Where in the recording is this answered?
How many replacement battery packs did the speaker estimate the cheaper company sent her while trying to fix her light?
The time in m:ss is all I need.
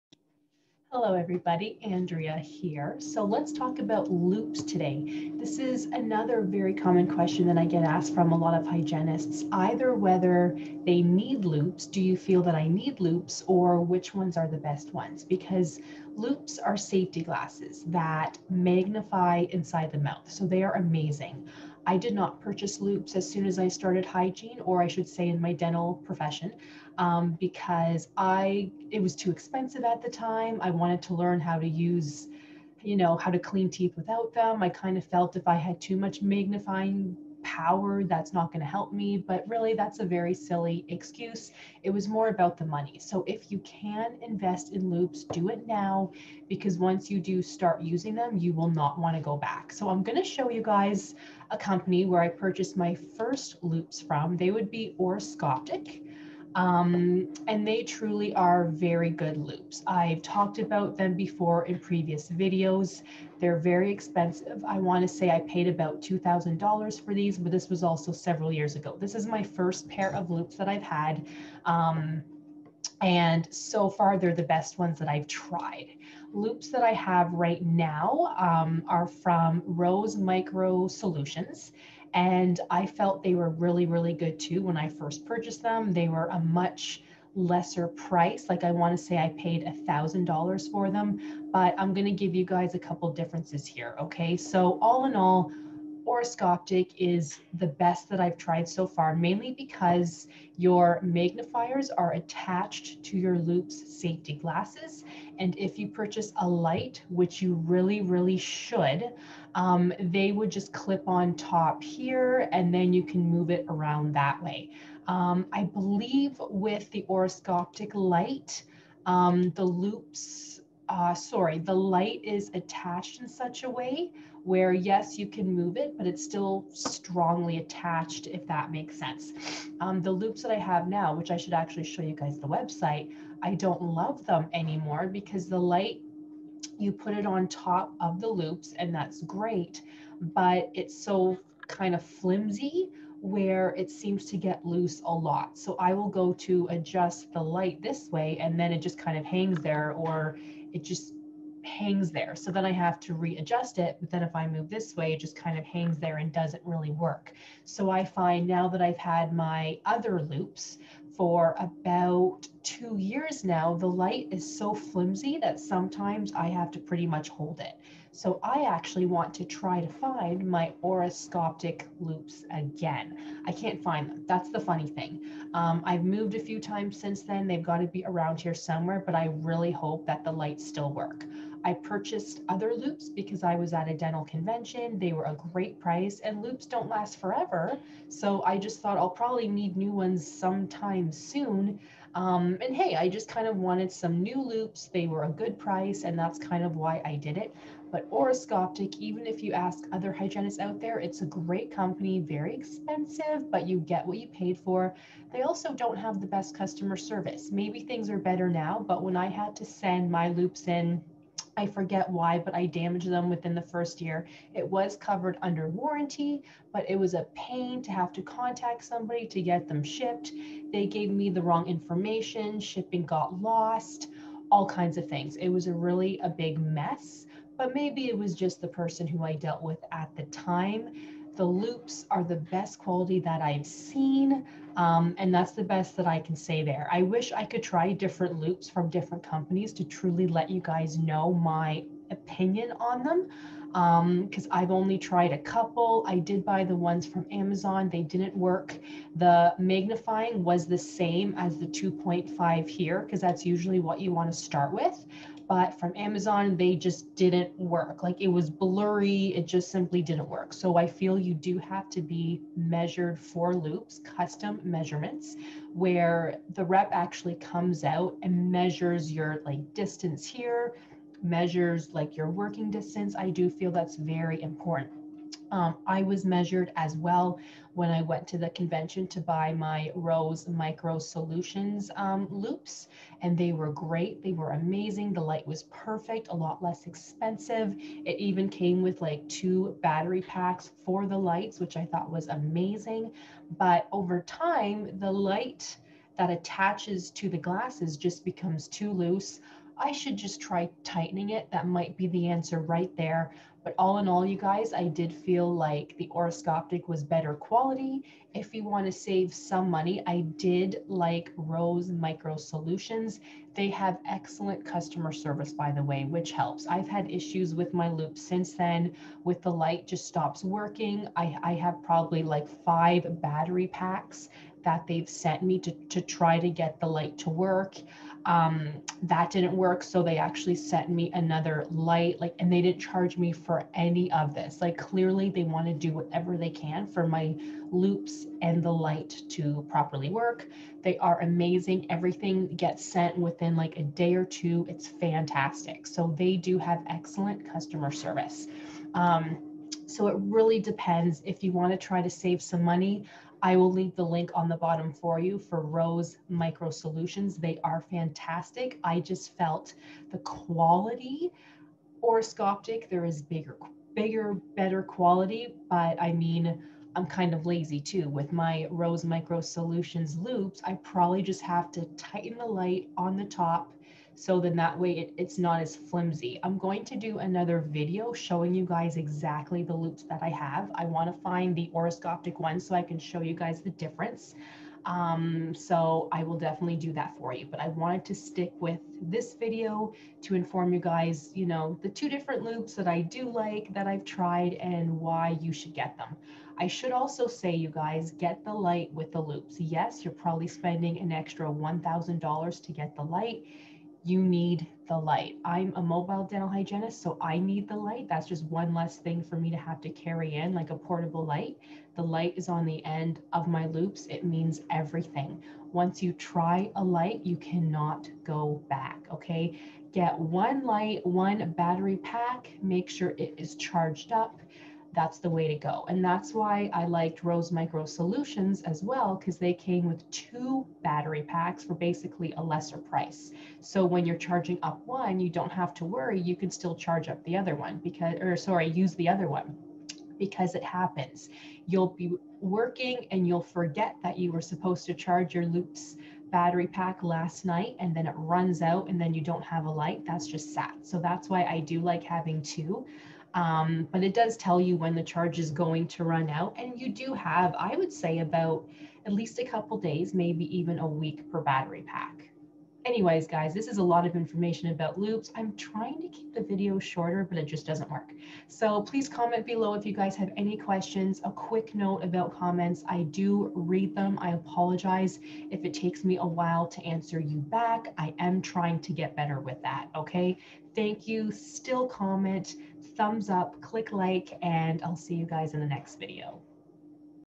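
5:22.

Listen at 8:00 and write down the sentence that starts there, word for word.
thank you, still comment, thumbs up, click like, and I'll see you guys in the next video.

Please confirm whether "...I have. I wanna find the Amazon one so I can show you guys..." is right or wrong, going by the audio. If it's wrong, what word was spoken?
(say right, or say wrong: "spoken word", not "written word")
wrong: "Orascoptic", not "Amazon".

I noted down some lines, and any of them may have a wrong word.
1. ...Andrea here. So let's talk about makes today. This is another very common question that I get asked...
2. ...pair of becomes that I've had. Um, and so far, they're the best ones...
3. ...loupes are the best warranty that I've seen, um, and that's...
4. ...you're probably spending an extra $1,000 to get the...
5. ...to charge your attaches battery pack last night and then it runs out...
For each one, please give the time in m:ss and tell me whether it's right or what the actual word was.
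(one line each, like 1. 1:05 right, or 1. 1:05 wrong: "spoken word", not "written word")
1. 0:01 wrong: "loupes", not "makes"
2. 1:09 wrong: "loupes", not "becomes"
3. 3:51 wrong: "quality", not "warranty"
4. 6:40 right
5. 7:24 wrong: "loupes", not "attaches".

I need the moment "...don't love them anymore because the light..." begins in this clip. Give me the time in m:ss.
2:13.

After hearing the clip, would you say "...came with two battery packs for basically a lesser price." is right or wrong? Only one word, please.
right.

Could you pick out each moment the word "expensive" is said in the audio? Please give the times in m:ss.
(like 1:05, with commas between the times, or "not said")
0:29, 1:03, 3:22, 4:46.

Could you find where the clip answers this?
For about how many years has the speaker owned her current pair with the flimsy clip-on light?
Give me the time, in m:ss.
2:42.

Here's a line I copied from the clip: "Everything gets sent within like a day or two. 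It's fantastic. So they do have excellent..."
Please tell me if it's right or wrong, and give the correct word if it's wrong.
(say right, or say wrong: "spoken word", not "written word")
right.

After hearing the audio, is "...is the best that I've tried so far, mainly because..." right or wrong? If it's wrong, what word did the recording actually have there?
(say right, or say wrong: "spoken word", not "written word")
right.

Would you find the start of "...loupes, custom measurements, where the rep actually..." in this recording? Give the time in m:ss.
4:23.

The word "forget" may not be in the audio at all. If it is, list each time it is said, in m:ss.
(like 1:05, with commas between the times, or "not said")
3:31, 7:23.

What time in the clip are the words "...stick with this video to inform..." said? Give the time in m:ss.
6:28.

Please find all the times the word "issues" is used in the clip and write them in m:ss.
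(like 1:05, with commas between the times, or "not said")
5:17.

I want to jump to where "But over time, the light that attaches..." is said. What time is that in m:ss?
4:53.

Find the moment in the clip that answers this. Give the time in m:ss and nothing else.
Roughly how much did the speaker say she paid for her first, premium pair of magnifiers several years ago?
1:06.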